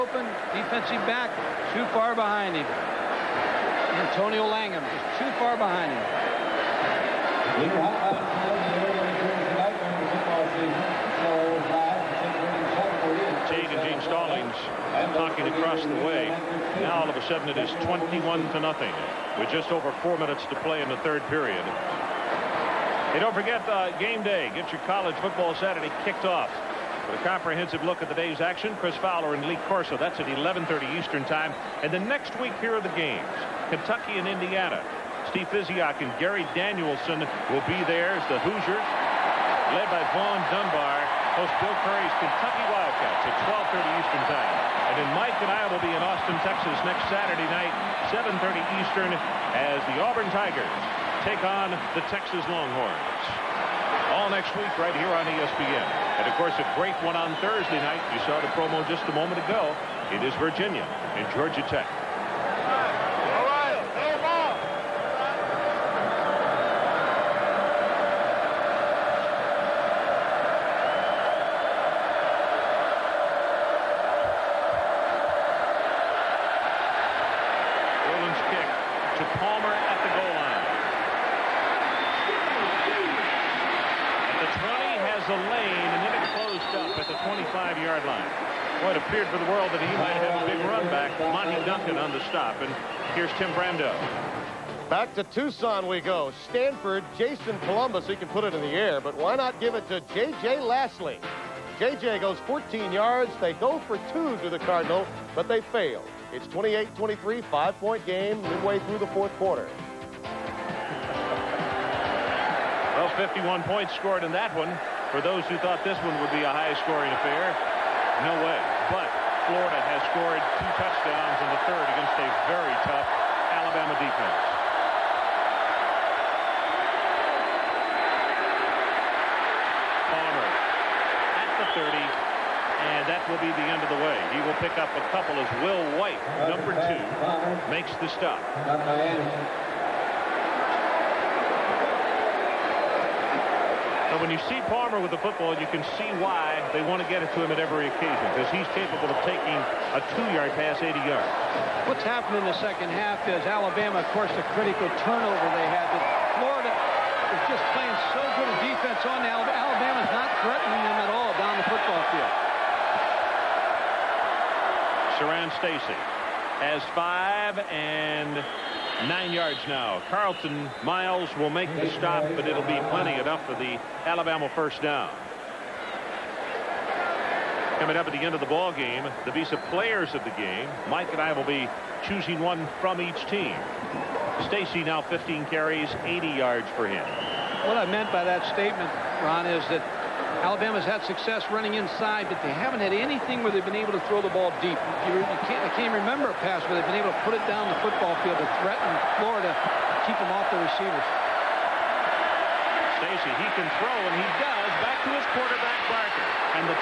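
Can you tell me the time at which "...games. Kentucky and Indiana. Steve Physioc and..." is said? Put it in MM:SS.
00:32.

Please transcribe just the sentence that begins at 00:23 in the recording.
Hey, don't forget uh, game day.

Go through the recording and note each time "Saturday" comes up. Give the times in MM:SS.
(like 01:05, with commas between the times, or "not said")
00:25, 00:47.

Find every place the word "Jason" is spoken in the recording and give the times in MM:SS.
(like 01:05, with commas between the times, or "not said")
01:37.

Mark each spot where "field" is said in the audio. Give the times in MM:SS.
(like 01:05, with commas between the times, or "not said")
02:42, 03:18.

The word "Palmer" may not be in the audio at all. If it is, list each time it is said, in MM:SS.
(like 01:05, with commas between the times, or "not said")
02:10, 02:24.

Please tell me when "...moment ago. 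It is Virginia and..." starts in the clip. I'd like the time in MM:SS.
00:59.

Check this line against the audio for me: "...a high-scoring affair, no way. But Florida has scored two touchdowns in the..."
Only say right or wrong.
right.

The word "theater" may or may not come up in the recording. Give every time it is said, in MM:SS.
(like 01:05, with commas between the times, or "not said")
not said.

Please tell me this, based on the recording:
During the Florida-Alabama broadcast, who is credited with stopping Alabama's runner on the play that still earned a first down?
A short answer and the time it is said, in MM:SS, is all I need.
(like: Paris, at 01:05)
Carlton Miles, at 02:50.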